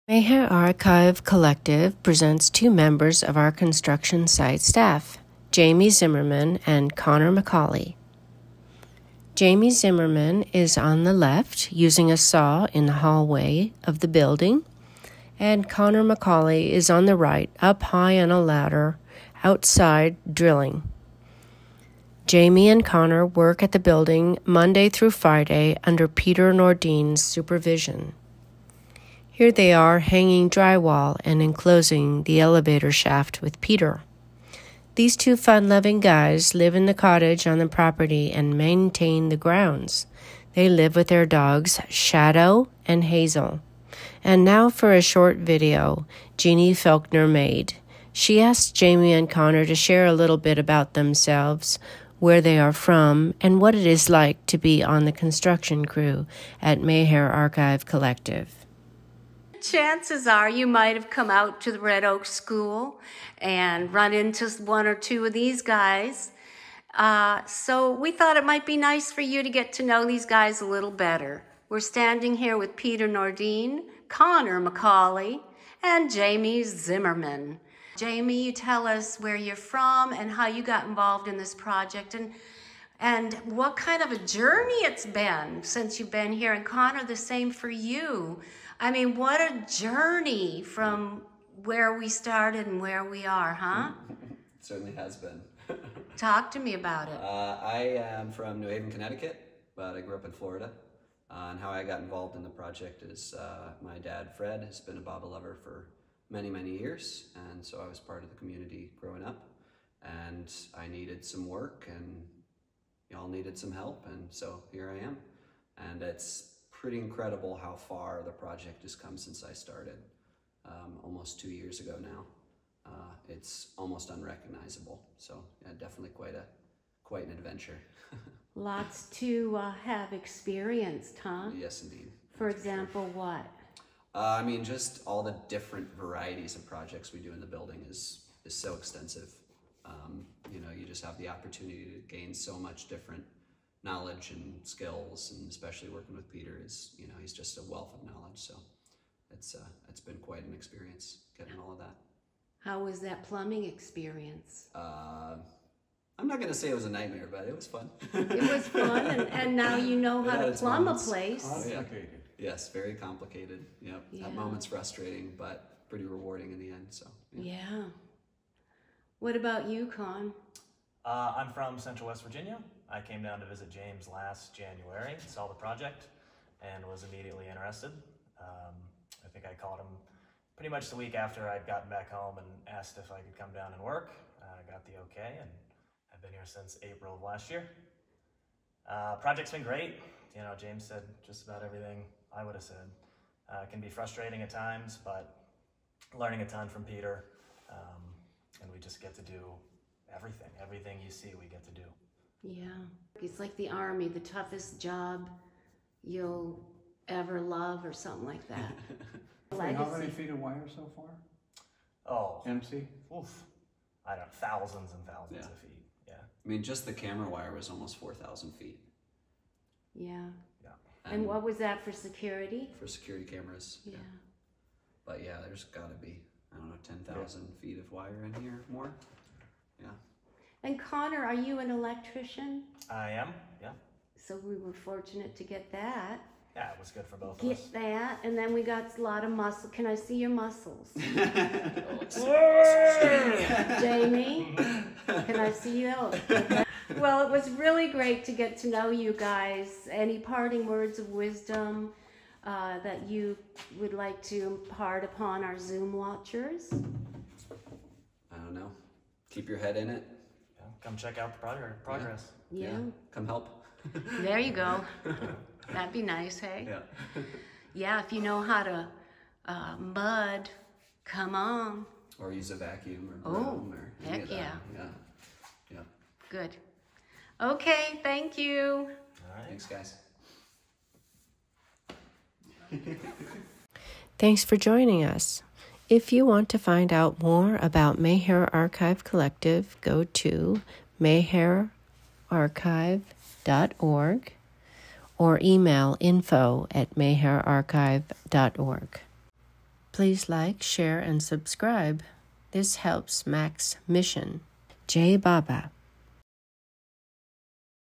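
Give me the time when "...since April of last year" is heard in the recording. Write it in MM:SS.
03:06.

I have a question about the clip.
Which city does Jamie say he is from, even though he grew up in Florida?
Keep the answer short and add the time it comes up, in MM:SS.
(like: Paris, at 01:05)
New Haven, Connecticut, at 01:38.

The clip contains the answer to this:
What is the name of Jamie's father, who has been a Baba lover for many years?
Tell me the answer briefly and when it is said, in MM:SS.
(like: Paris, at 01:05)
Fred, at 01:44.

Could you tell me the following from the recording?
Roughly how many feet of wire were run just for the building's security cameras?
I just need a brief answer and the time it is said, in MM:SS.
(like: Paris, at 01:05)
almost 4,000 feet, at 03:37.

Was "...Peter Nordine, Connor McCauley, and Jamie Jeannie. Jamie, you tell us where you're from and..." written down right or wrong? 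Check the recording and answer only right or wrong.
wrong.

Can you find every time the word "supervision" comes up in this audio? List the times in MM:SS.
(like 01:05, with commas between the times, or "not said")
00:27.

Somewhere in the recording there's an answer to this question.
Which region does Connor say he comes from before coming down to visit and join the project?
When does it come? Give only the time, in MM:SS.
02:51.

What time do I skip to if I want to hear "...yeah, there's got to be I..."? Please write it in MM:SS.
03:45.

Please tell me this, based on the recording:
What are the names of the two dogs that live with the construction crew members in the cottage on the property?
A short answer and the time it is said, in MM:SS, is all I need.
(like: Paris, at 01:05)
Shadow and Hazel, at 00:41.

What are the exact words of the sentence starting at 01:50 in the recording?
And I needed some work and y'all needed some help, and so here I am.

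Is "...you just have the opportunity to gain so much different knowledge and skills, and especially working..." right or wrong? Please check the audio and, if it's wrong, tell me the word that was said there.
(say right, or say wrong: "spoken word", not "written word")
right.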